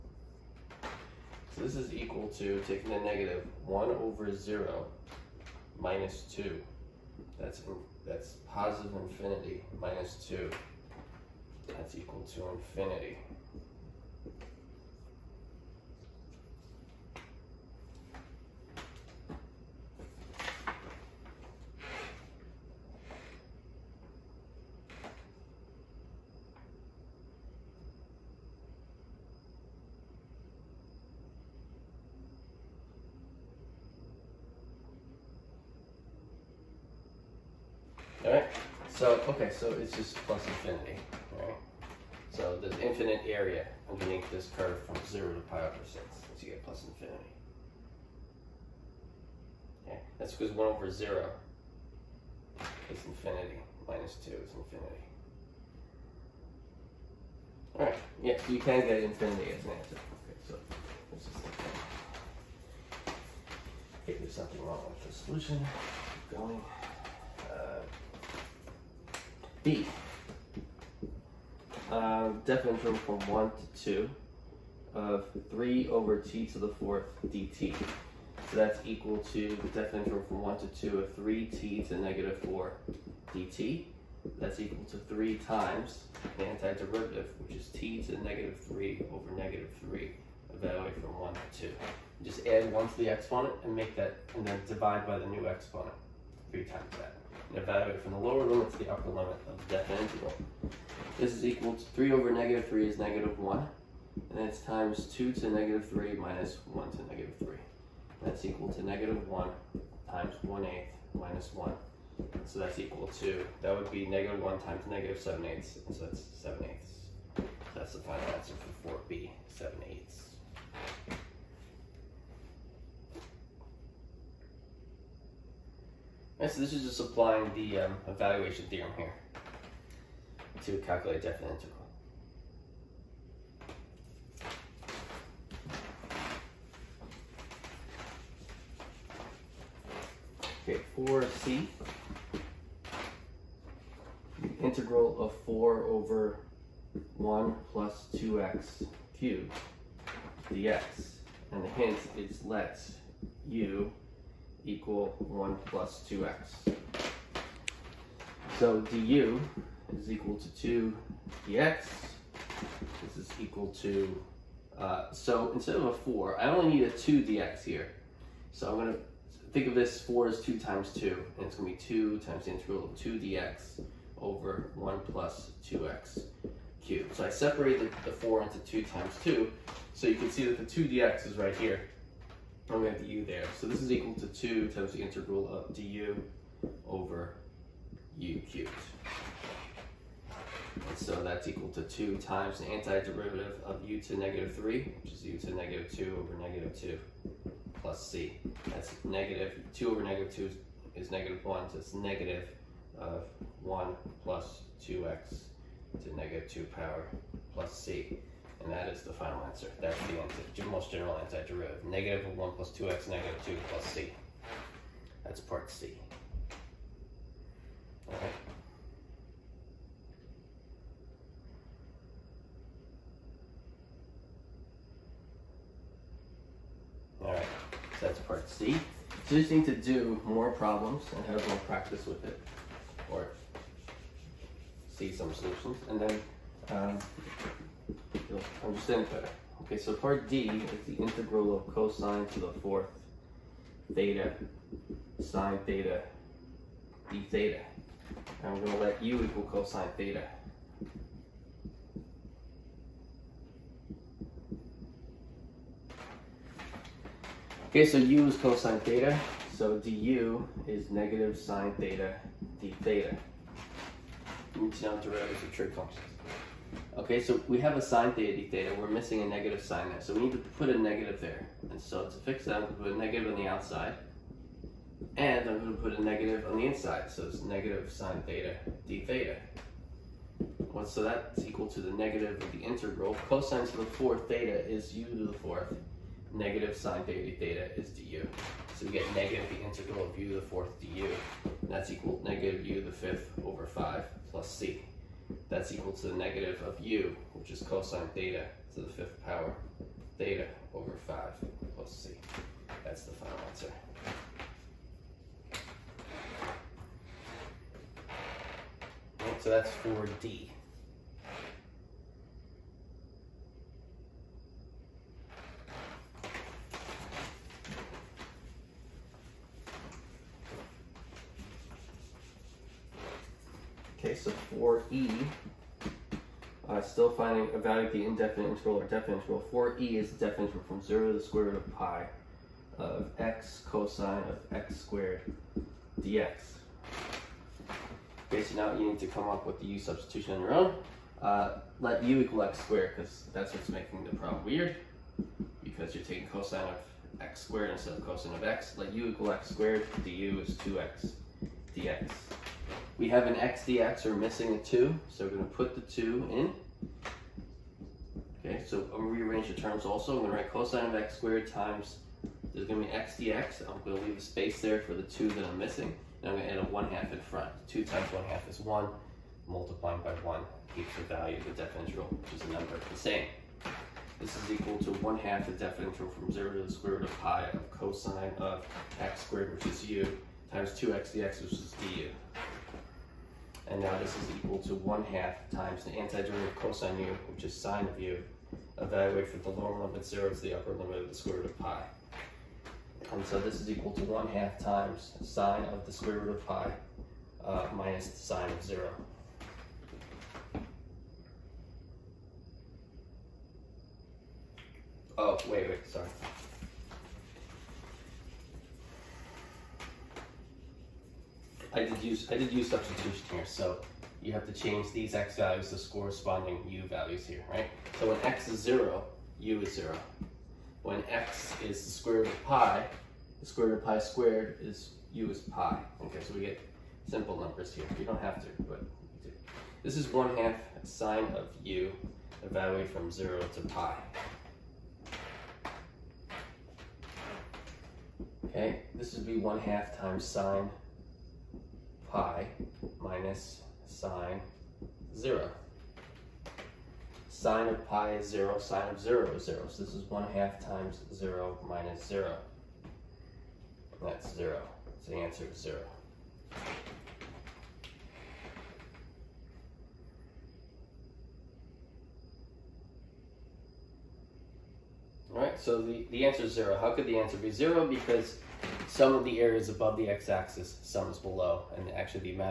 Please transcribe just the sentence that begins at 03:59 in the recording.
Okay, so part D is the integral of cosine to the fourth theta sine theta d theta.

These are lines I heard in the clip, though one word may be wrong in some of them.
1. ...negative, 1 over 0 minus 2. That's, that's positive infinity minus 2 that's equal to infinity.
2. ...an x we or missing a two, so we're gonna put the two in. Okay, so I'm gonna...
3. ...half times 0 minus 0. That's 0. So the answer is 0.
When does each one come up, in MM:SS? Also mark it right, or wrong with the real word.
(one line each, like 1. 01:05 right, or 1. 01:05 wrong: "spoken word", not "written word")
1. 00:02 right
2. 05:53 right
3. 07:30 right.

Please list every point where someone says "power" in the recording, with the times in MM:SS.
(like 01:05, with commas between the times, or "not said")
03:26, 04:59.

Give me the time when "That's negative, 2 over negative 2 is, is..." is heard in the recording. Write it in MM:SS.
03:18.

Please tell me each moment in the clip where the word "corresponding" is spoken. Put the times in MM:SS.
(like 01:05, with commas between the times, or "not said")
06:55.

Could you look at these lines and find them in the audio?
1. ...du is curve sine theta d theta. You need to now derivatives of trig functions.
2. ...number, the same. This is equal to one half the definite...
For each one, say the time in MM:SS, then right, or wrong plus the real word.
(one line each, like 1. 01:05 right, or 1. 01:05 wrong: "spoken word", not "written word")
1. 04:19 wrong: "negative", not "curve"
2. 06:12 right.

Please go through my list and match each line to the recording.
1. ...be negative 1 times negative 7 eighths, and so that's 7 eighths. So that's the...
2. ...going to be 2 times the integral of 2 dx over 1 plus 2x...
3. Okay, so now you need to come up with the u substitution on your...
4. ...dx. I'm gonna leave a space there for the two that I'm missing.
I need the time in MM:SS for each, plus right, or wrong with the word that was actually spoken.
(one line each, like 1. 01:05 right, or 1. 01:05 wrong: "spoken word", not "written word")
1. 01:53 right
2. 02:51 right
3. 05:38 right
4. 06:03 right.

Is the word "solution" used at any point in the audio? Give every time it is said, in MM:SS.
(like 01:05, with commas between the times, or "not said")
01:05, 03:55.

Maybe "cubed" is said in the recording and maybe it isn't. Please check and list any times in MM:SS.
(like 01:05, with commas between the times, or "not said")
02:29, 02:56, 03:08.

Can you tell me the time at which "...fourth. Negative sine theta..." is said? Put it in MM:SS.
04:45.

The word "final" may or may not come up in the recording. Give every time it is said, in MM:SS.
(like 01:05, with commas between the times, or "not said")
01:57, 03:29, 05:03.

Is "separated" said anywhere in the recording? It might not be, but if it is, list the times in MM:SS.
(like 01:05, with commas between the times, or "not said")
02:57.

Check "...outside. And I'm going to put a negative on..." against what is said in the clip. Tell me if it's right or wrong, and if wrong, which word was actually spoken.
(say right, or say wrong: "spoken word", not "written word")
right.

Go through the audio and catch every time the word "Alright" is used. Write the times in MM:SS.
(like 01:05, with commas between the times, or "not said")
00:38, 00:57.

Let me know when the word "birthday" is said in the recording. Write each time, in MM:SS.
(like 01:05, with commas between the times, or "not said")
not said.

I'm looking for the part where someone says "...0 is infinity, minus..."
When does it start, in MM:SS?
00:50.